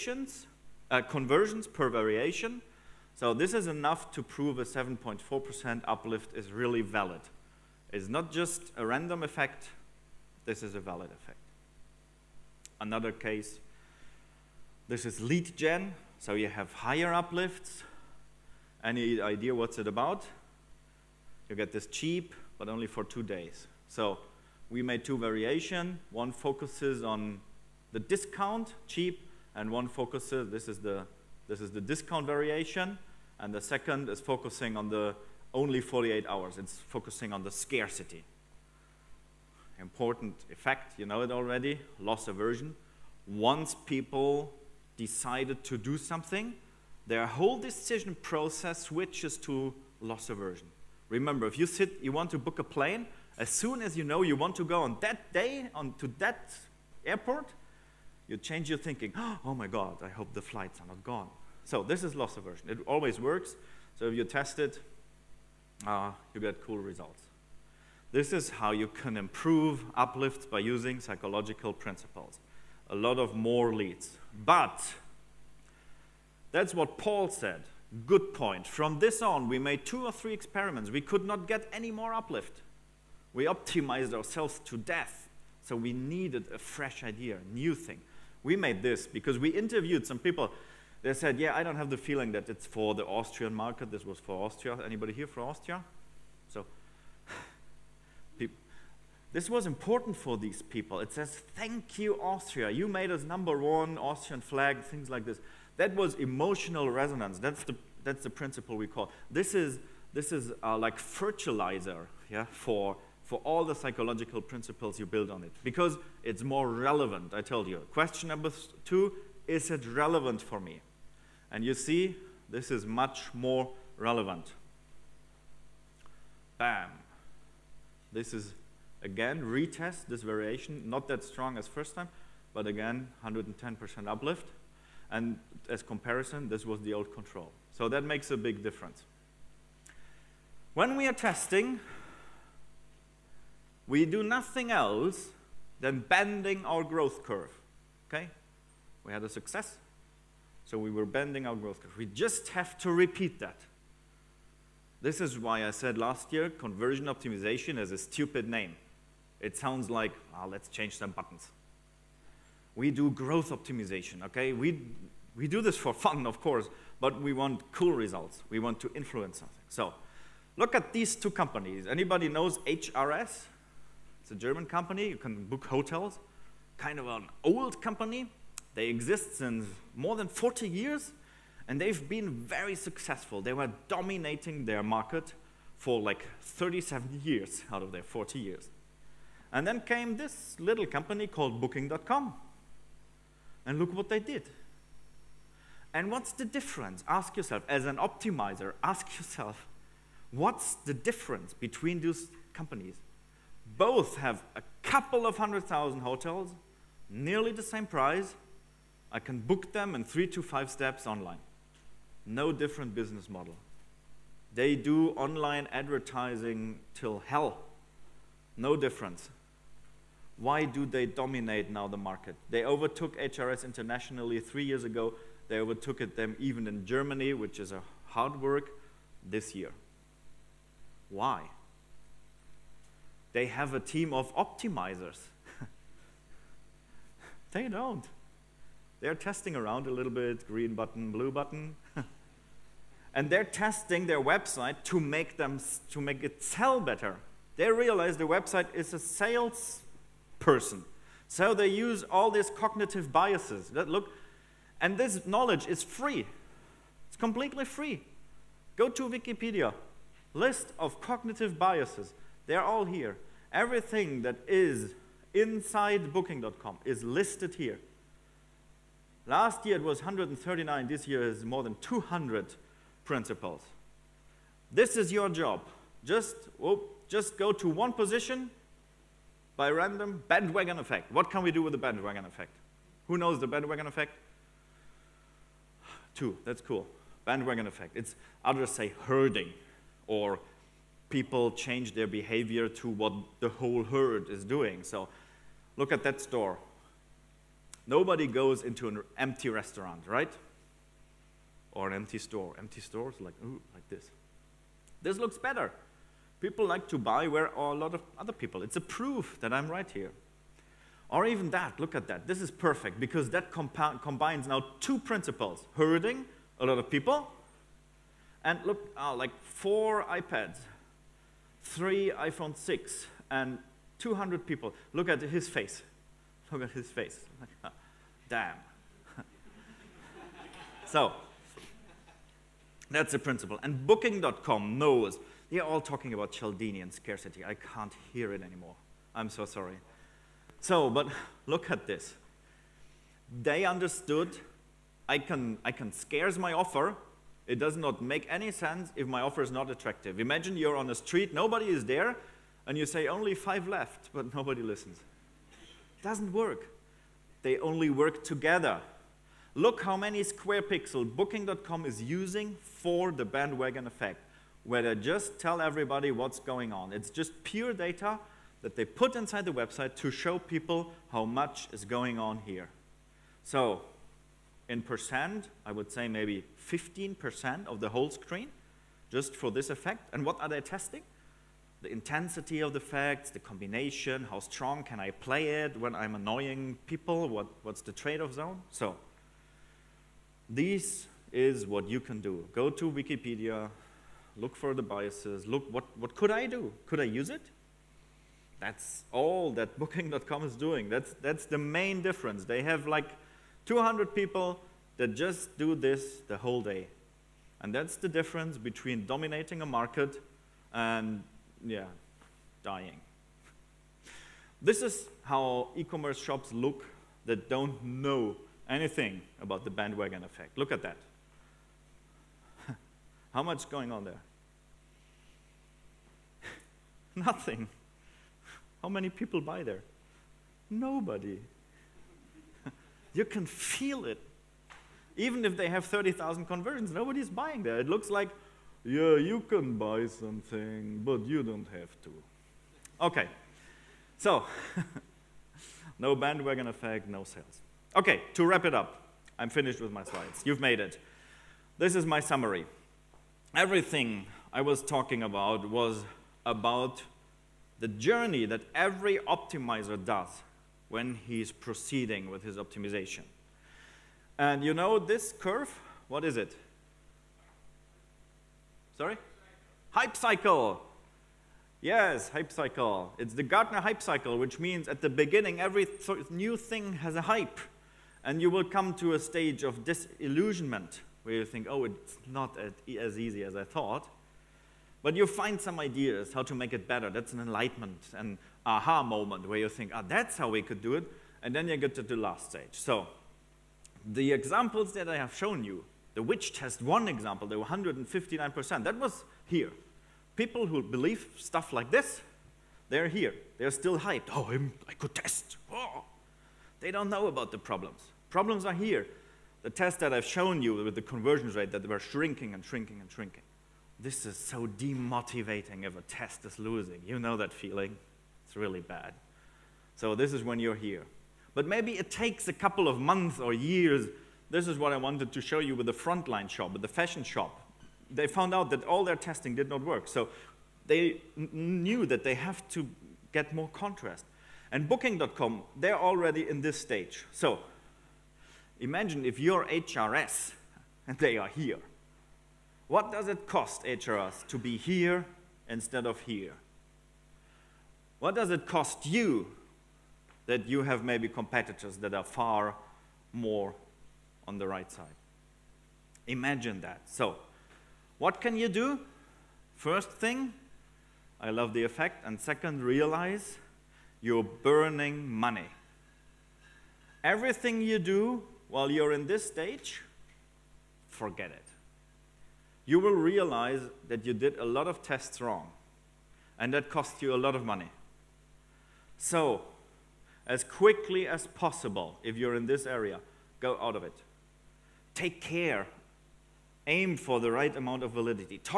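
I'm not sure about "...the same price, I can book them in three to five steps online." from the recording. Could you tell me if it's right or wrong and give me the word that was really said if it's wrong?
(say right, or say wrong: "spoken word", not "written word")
right.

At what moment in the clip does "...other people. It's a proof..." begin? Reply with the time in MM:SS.
05:08.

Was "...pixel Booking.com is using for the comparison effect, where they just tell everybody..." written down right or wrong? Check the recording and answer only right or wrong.
wrong.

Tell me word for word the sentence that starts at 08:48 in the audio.
They found out that all their testing did not work.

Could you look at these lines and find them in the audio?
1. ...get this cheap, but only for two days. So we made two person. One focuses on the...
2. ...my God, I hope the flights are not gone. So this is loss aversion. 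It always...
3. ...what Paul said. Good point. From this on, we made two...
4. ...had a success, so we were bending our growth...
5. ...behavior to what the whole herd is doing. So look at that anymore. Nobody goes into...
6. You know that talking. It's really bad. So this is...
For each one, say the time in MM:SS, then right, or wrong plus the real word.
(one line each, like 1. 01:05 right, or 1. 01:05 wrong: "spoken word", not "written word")
1. 00:21 wrong: "variation", not "person"
2. 00:59 right
3. 01:16 right
4. 02:29 right
5. 04:52 wrong: "store", not "anymore"
6. 08:37 wrong: "feeling", not "talking".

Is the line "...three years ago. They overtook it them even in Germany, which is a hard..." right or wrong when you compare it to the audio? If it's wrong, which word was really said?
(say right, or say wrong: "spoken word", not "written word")
right.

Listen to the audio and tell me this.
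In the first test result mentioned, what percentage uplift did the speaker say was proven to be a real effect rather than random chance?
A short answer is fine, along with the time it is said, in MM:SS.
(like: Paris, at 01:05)
7.4%, at 00:04.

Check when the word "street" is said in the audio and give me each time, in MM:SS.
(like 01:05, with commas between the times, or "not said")
05:50.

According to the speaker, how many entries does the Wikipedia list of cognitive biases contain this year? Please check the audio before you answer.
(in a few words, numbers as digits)
more than 200.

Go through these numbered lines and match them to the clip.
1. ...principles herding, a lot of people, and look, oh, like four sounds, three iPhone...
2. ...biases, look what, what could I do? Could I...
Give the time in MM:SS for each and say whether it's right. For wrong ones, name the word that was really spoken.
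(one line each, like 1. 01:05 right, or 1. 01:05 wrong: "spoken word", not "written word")
1. 05:14 wrong: "iPads", not "sounds"
2. 06:34 right.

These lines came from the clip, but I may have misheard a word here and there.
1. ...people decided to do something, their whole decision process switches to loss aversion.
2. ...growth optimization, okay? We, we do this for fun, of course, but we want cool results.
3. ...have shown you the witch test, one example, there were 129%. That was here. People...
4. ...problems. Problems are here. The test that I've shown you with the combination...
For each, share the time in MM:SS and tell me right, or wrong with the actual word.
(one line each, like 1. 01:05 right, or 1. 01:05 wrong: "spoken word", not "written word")
1. 00:43 right
2. 02:43 right
3. 08:15 wrong: "159", not "129"
4. 08:27 wrong: "conversion", not "combination".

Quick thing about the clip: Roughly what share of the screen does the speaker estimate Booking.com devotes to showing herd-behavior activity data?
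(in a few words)
15%.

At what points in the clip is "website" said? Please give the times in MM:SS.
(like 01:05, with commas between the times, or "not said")
04:04, 04:08, 06:09.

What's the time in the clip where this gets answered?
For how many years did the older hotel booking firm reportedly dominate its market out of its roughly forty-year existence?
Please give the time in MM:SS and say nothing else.
03:06.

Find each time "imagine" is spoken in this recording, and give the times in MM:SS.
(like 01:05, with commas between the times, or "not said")
05:50, 08:58, 09:16.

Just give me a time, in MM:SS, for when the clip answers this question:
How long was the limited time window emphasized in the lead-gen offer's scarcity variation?
00:35.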